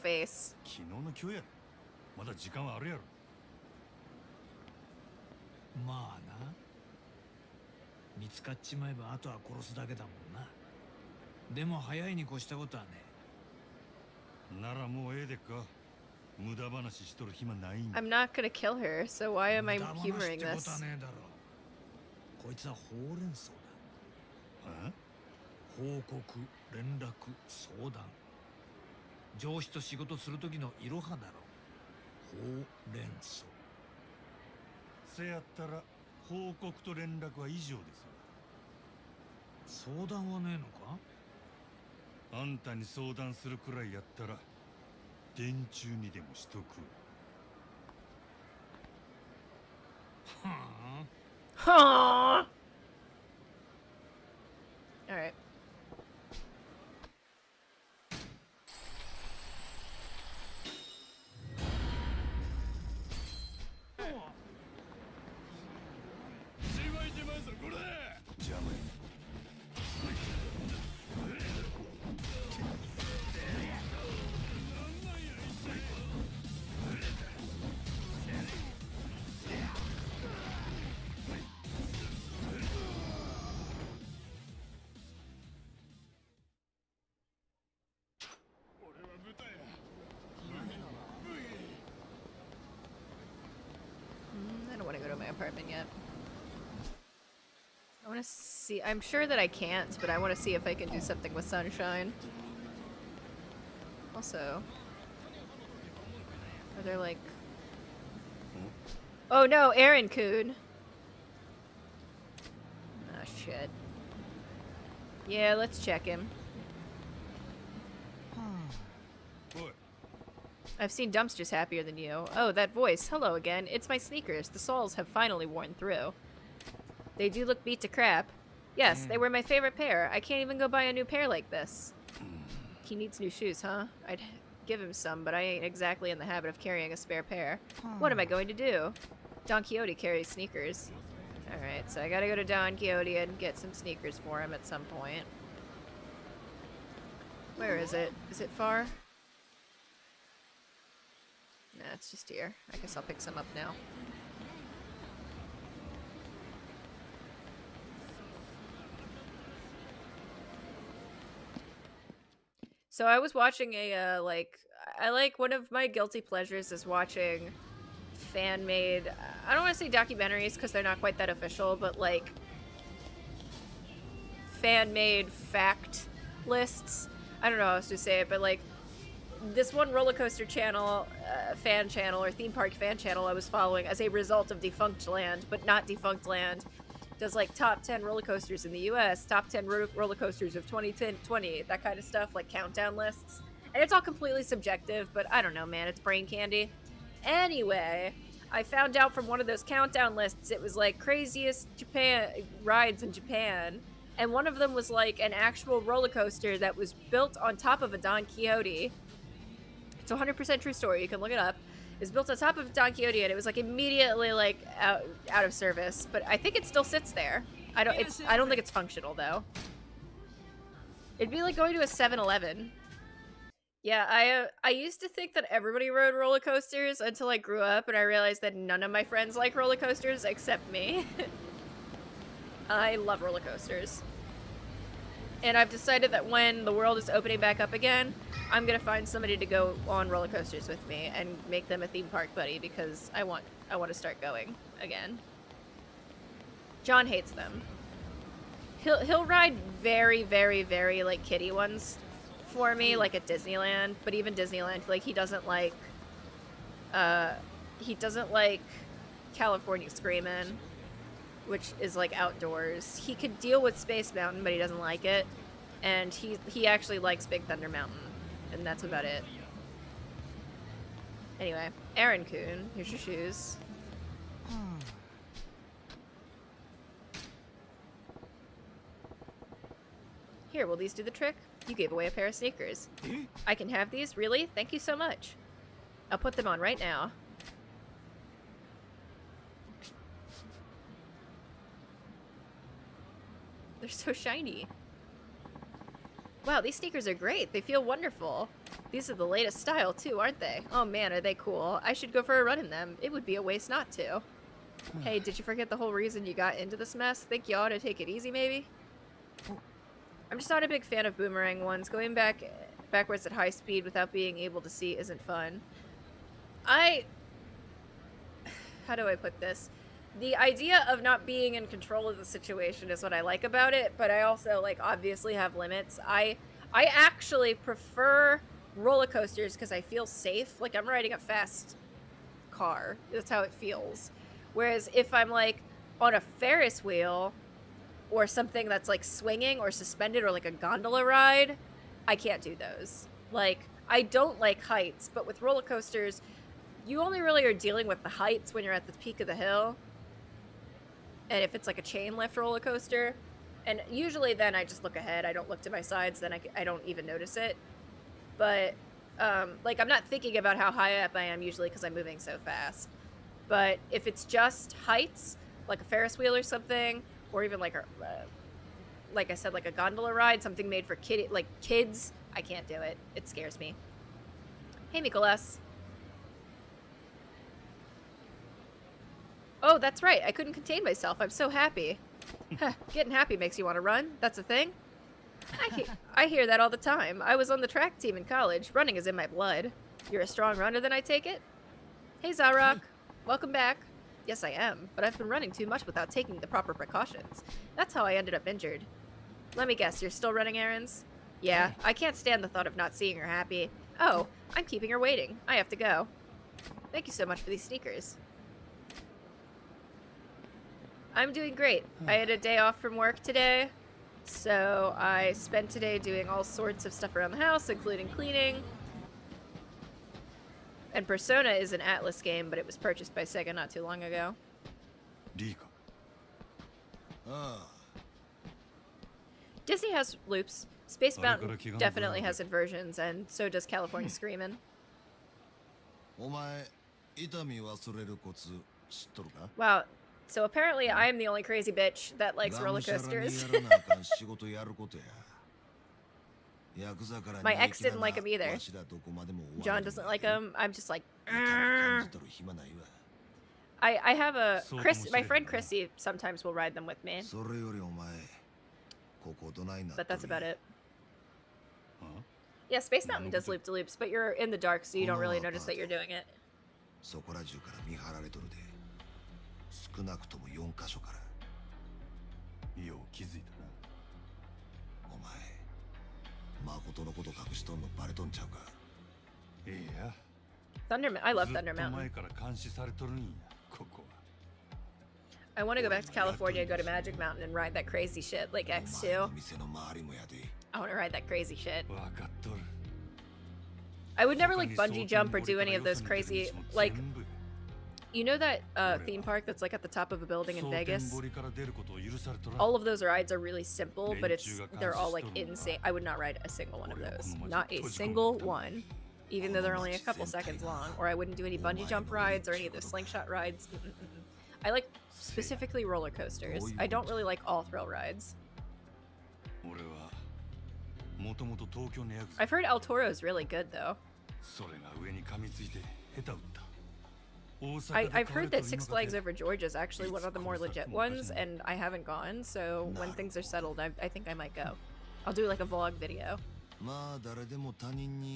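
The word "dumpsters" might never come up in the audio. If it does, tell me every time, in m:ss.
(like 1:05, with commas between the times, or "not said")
2:01.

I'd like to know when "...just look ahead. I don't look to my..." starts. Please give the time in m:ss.
5:54.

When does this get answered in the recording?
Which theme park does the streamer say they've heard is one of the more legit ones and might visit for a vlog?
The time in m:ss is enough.
8:48.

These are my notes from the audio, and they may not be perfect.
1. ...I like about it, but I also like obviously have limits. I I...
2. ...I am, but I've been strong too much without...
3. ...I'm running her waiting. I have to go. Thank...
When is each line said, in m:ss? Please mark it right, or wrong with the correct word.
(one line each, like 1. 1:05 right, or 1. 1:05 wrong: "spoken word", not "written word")
1. 5:23 right
2. 6:34 wrong: "running", not "strong"
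3. 6:44 wrong: "keeping", not "running".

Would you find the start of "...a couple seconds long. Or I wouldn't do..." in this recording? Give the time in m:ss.
8:29.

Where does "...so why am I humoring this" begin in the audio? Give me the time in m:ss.
0:19.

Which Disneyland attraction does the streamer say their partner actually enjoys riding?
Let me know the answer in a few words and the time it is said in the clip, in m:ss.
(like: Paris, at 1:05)
Big Thunder Mountain, at 4:27.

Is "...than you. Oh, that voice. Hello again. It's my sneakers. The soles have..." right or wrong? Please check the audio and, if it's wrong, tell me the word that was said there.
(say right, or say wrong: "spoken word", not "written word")
right.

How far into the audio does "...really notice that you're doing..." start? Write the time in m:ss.
7:45.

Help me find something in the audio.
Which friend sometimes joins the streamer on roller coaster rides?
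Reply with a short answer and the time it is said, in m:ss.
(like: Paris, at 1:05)
Chrissy, at 7:35.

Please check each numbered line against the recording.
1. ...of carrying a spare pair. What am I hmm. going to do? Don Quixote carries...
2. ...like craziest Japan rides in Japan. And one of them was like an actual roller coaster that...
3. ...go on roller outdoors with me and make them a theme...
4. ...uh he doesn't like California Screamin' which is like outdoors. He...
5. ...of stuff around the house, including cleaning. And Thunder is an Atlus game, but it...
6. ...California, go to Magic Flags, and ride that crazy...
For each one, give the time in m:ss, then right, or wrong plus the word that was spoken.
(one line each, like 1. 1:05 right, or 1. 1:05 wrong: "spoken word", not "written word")
1. 2:16 right
2. 3:20 right
3. 3:59 wrong: "coasters", not "outdoors"
4. 4:16 right
5. 6:56 wrong: "Persona", not "Thunder"
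6. 8:06 wrong: "Mountain", not "Flags".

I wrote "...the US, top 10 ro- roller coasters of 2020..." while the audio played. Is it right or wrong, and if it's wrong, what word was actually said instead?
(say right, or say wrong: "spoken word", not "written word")
right.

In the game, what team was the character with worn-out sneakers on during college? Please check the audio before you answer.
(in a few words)
track team.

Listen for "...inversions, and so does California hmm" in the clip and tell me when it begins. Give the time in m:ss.
7:12.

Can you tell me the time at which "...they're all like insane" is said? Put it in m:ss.
8:24.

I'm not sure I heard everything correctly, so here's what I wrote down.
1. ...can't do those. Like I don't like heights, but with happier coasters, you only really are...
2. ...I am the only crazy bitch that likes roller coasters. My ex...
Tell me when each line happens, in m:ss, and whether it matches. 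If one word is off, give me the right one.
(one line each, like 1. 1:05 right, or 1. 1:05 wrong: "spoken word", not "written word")
1. 5:42 wrong: "roller", not "happier"
2. 7:20 right.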